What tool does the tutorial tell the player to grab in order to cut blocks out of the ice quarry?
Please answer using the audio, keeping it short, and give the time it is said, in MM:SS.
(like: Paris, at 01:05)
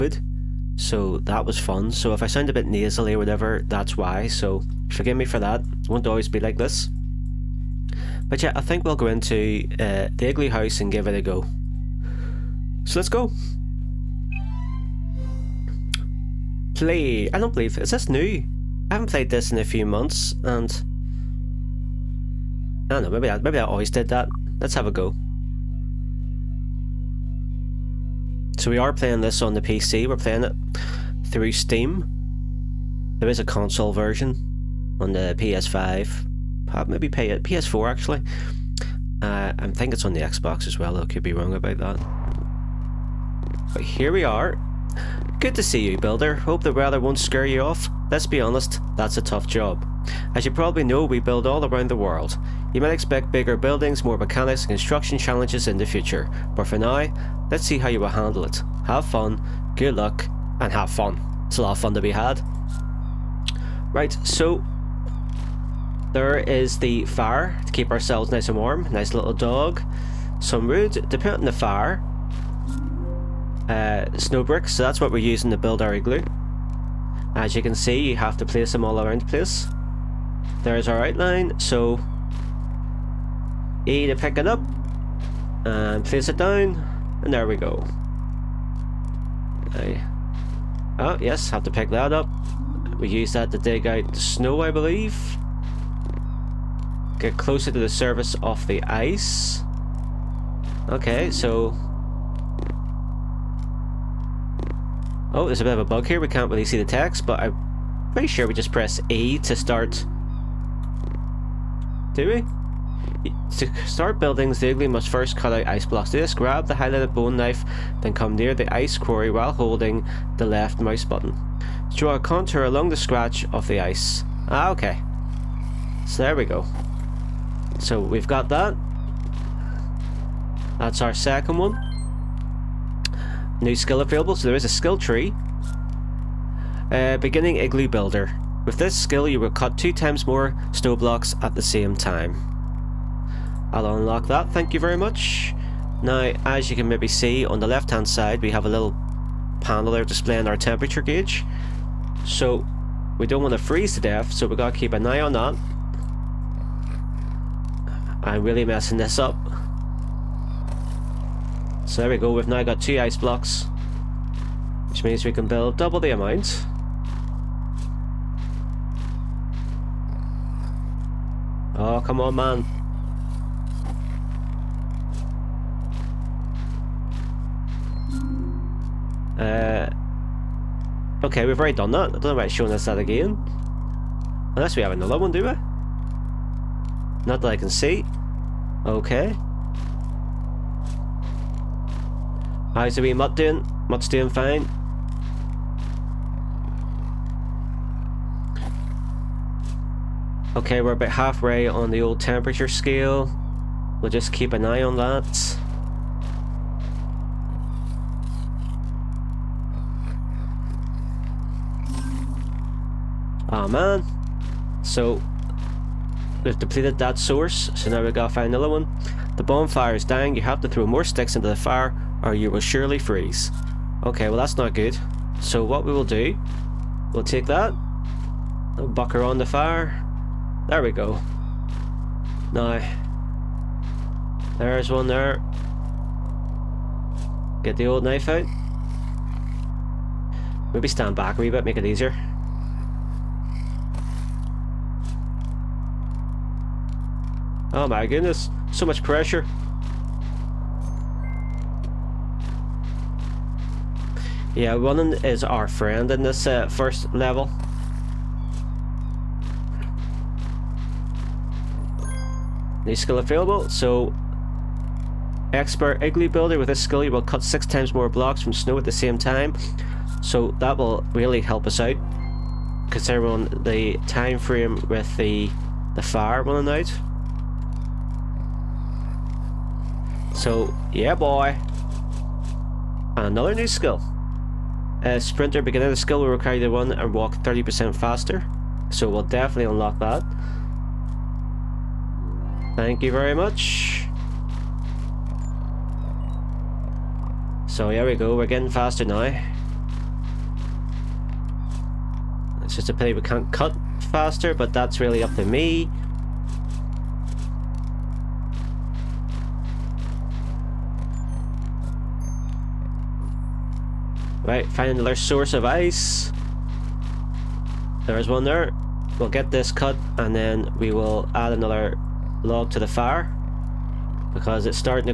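Bone knife, at 01:57.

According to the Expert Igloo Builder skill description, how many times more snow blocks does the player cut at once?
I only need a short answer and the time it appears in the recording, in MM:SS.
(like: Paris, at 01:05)
6, at 04:27.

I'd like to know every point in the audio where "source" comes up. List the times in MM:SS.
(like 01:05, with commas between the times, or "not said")
03:37, 05:15.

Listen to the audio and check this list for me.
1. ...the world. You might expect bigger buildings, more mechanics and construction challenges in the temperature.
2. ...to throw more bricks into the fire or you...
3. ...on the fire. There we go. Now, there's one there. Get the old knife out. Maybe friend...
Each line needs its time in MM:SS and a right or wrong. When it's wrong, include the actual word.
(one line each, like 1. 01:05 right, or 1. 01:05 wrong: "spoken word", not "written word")
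1. 00:51 wrong: "future", not "temperature"
2. 03:40 wrong: "sticks", not "bricks"
3. 03:49 wrong: "stand", not "friend".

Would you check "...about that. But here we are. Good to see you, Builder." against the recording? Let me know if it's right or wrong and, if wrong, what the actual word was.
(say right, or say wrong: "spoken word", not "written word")
right.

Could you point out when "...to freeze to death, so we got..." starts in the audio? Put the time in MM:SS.
02:33.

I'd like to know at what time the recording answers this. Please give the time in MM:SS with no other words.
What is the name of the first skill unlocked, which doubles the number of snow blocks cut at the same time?
02:17.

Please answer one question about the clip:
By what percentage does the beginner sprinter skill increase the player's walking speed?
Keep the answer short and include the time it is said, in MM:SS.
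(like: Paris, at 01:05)
30%, at 04:47.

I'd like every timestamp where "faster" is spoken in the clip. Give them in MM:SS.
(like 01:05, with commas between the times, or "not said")
04:47, 04:58, 05:03.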